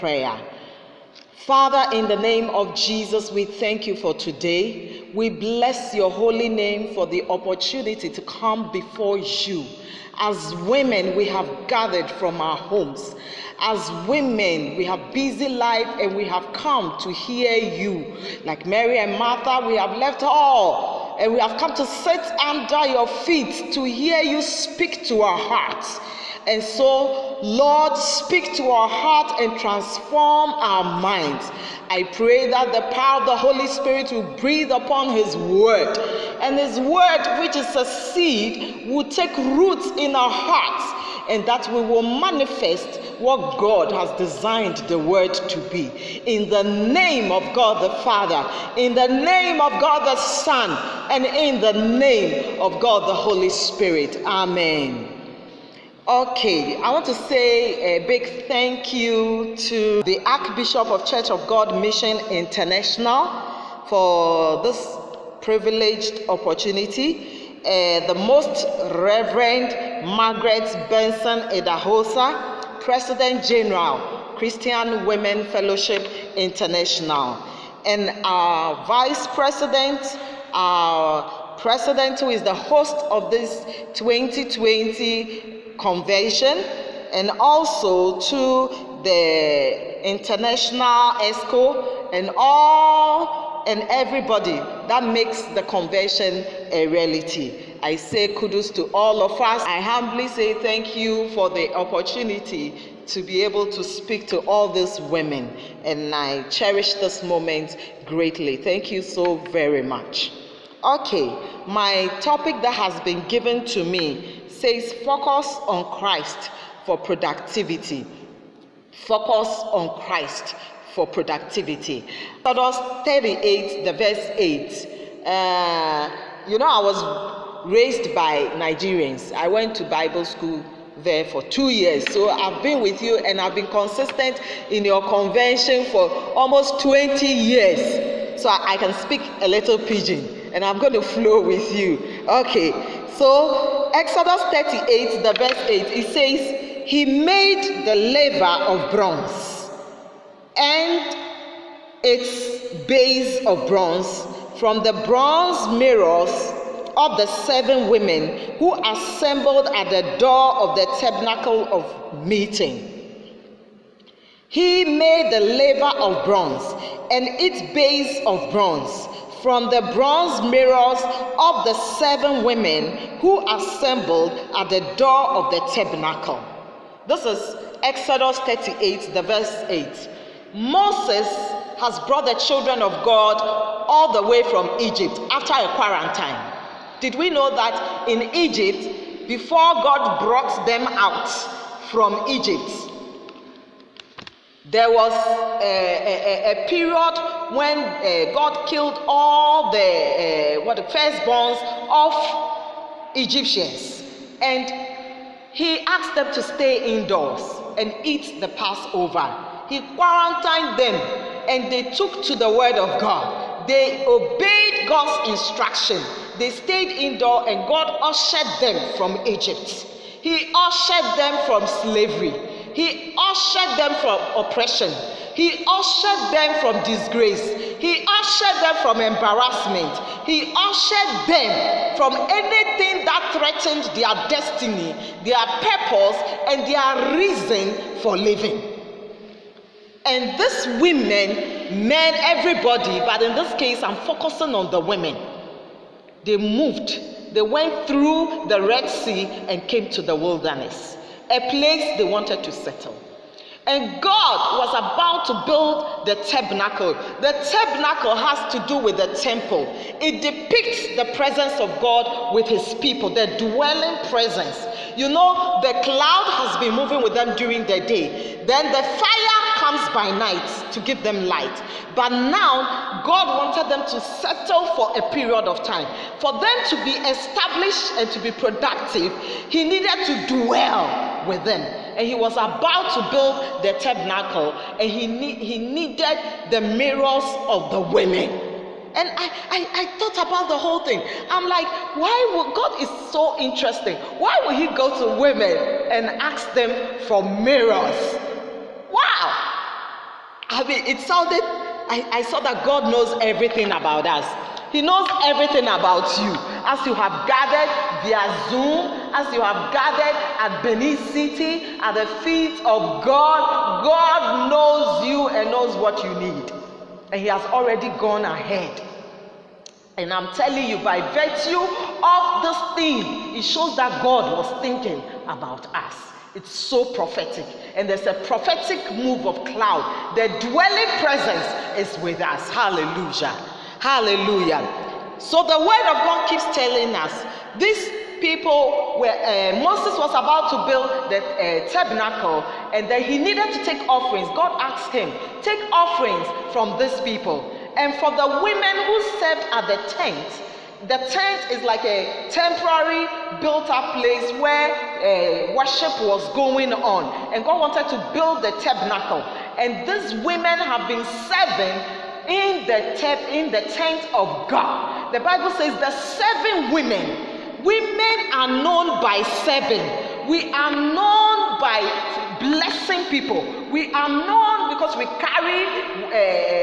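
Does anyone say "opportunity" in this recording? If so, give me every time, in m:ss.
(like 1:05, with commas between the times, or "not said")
0:07, 1:06, 1:41.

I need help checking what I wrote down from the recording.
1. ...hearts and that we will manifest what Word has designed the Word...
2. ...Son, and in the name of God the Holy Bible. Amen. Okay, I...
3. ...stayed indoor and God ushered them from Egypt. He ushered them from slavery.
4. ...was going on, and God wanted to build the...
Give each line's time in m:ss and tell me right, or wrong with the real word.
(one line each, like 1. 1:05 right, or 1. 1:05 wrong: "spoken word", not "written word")
1. 0:40 wrong: "God", not "Word"
2. 0:50 wrong: "Spirit", not "Bible"
3. 3:36 right
4. 5:56 right.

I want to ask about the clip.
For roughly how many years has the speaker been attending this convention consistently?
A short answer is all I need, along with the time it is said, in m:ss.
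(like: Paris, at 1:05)
almost 20 years, at 2:16.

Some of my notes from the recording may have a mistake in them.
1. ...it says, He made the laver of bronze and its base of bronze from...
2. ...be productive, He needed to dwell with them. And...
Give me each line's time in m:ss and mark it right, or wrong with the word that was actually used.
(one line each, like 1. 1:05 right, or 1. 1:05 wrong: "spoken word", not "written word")
1. 2:25 right
2. 4:38 right.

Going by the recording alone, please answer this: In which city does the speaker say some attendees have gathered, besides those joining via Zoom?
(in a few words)
Benin City.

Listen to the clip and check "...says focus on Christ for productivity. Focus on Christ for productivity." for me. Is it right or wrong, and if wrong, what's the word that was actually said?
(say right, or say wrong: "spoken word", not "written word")
right.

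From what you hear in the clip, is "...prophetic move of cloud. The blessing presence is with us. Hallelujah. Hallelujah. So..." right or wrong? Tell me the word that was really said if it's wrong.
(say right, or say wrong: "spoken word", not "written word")
wrong: "dwelling", not "blessing".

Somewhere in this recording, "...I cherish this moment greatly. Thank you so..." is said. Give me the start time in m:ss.
1:46.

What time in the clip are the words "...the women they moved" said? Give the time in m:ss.
4:04.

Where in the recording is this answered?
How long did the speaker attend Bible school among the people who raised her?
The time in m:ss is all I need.
2:11.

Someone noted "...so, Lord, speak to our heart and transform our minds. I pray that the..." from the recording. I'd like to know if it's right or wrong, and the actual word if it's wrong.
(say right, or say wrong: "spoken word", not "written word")
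right.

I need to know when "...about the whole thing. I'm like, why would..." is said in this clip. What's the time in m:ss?
4:50.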